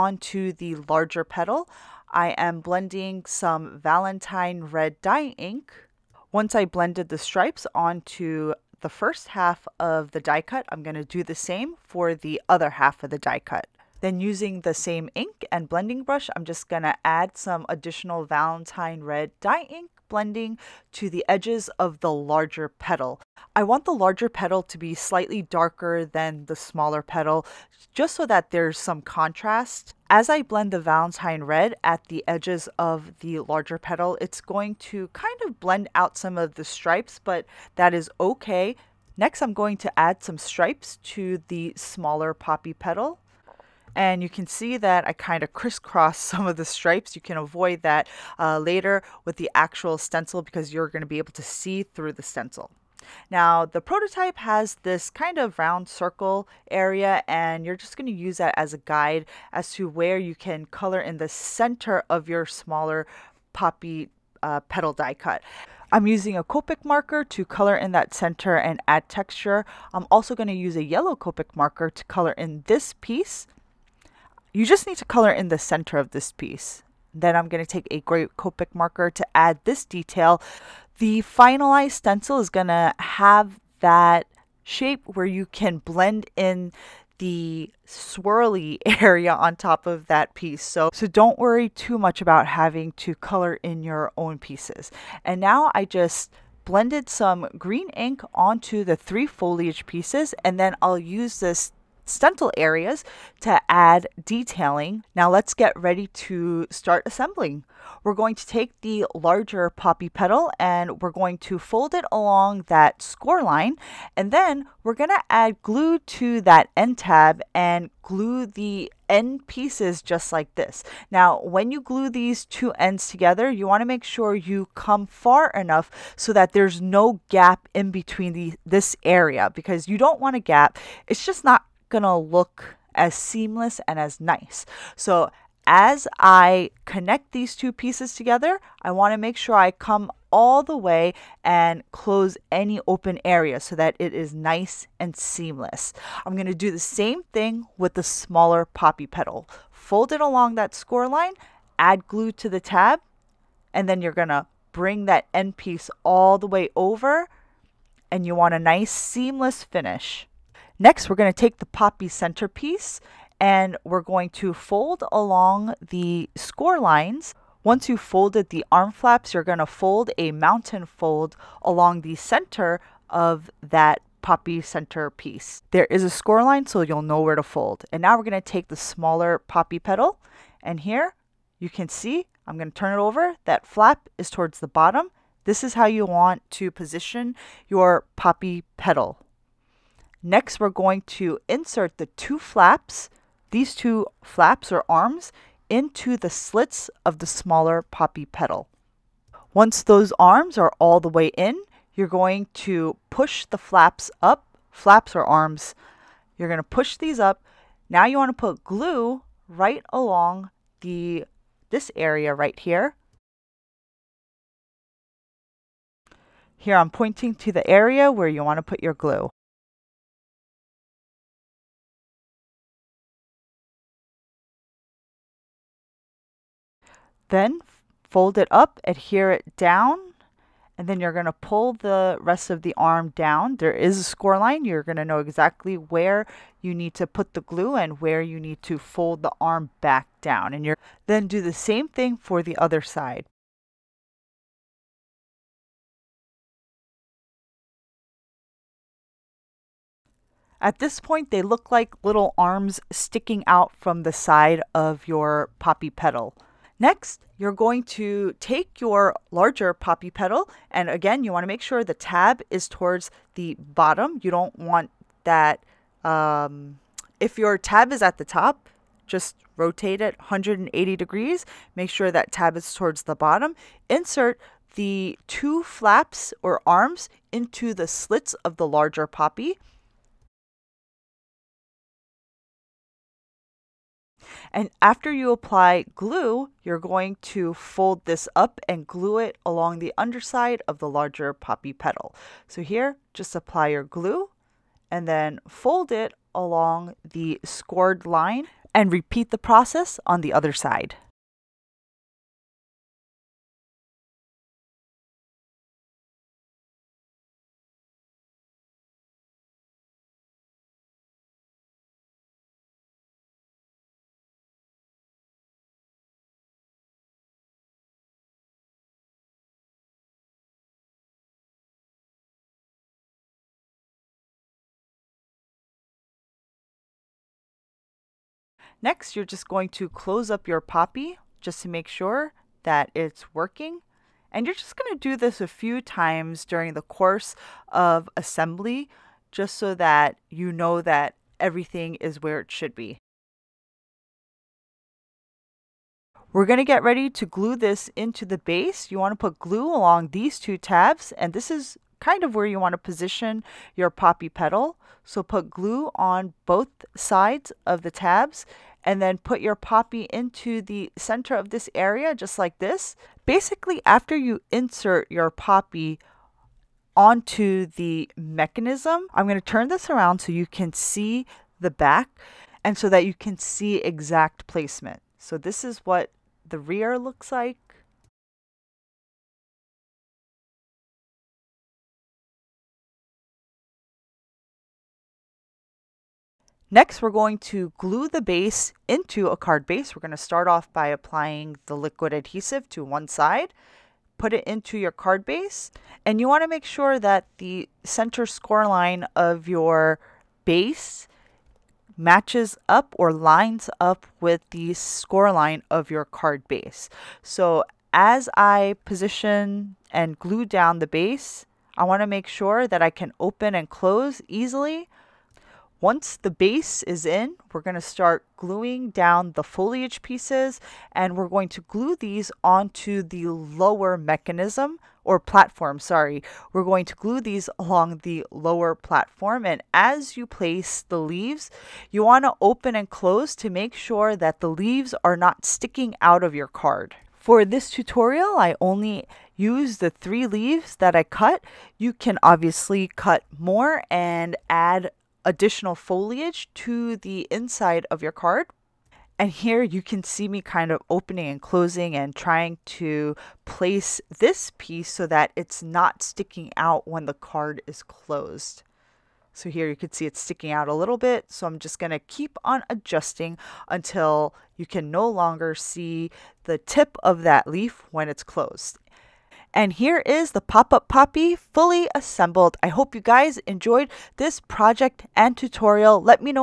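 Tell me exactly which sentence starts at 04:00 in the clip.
And you're then do the same thing for the other side.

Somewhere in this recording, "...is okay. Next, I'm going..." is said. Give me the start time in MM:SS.
00:37.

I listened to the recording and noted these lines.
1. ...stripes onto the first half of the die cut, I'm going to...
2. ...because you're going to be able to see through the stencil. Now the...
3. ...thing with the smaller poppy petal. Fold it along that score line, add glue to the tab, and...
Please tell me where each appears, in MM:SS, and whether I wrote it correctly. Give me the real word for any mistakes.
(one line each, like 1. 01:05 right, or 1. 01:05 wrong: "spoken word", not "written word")
1. 00:07 right
2. 00:50 right
3. 02:27 right.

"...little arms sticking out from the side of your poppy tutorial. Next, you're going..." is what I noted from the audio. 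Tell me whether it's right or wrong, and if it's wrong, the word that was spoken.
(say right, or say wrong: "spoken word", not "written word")
wrong: "petal", not "tutorial".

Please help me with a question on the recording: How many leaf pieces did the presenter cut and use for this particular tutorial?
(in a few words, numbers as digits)
3.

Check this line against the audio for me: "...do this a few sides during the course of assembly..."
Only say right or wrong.
wrong.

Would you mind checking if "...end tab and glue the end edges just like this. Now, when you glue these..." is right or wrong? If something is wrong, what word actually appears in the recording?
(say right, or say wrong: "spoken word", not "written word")
wrong: "pieces", not "edges".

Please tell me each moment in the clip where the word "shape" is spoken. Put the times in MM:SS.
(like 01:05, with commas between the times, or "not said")
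01:24.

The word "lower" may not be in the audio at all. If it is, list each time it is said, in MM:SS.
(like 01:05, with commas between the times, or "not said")
07:03, 07:08.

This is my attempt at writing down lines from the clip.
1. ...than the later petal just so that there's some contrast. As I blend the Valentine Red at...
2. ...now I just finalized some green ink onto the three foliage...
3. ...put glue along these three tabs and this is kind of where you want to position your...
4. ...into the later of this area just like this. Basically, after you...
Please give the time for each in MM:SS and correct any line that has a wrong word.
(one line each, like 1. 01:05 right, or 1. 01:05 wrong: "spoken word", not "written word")
1. 00:26 wrong: "smaller", not "later"
2. 01:35 wrong: "blended", not "finalized"
3. 05:49 wrong: "two", not "three"
4. 06:00 wrong: "center", not "later".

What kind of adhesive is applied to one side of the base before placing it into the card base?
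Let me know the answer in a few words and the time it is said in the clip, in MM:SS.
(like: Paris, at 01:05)
liquid adhesive, at 06:31.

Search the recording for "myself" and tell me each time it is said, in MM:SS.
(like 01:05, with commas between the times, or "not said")
not said.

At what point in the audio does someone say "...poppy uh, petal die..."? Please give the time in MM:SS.
01:03.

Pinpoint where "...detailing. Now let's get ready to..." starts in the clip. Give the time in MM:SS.
01:44.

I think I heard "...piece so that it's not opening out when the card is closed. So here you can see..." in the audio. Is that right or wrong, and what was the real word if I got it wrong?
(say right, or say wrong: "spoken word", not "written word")
wrong: "sticking", not "opening".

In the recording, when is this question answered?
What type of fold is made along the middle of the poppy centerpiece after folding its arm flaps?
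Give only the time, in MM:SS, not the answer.
02:50.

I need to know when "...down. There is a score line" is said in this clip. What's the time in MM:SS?
03:53.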